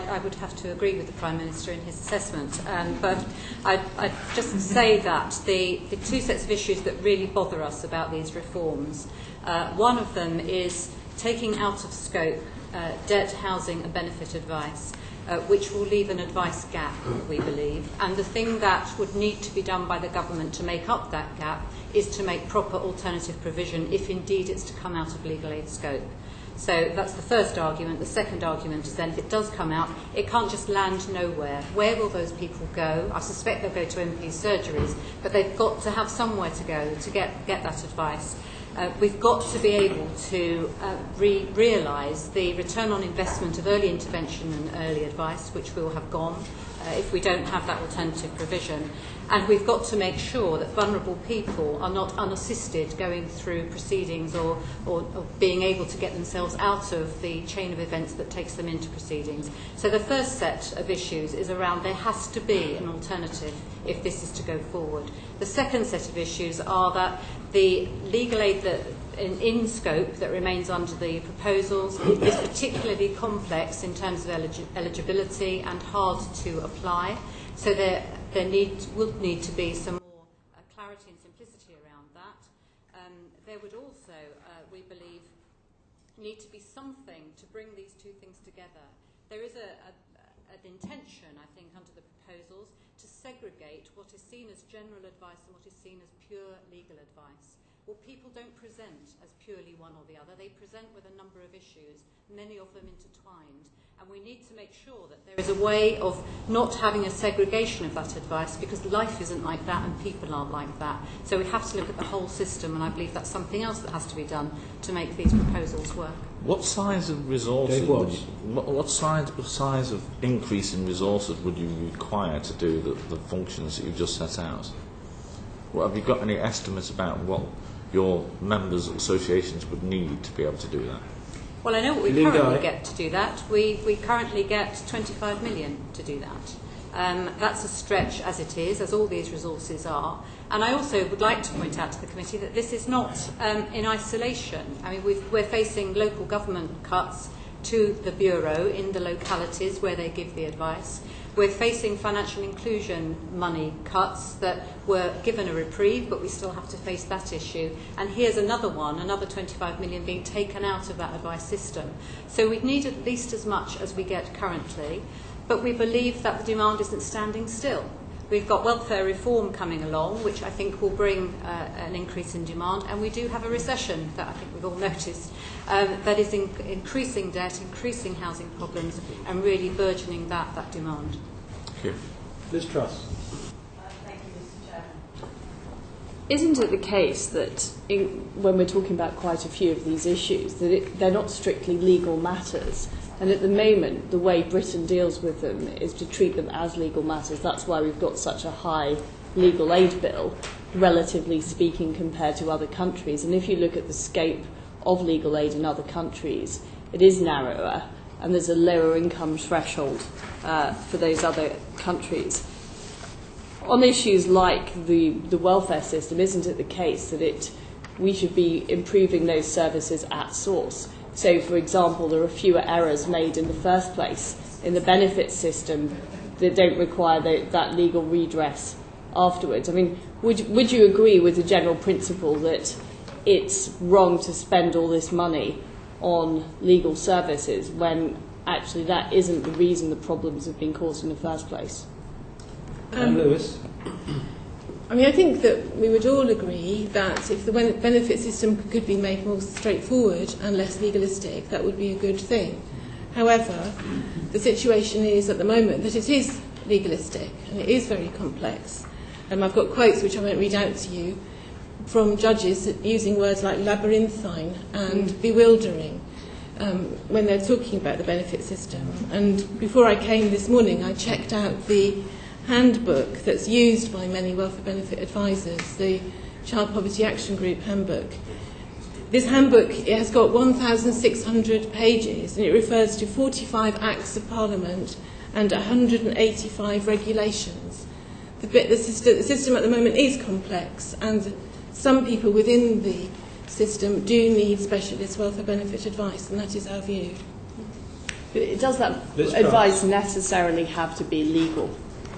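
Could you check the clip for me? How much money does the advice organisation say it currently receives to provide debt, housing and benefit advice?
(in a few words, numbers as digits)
25 million.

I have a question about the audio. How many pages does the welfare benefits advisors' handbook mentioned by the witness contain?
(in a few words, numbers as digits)
1,600.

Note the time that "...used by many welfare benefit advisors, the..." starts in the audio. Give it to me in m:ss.
4:33.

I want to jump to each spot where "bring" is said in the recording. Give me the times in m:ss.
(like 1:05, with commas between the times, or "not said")
1:27, 2:50.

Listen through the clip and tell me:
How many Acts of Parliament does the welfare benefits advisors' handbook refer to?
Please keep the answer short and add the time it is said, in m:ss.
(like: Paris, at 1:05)
45, at 4:43.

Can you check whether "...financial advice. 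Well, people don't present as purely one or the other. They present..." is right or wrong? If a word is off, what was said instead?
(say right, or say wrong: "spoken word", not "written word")
wrong: "legal", not "financial".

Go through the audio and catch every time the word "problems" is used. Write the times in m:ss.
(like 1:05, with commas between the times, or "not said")
2:58, 3:59.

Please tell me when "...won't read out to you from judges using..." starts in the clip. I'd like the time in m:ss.
4:20.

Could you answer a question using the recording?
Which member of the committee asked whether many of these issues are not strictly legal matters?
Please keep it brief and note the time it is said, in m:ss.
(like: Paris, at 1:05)
Liz Truss, at 3:02.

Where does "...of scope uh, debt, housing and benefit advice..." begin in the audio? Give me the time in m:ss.
0:11.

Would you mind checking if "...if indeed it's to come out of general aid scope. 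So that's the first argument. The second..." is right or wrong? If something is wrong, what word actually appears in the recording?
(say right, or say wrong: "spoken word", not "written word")
wrong: "legal", not "general".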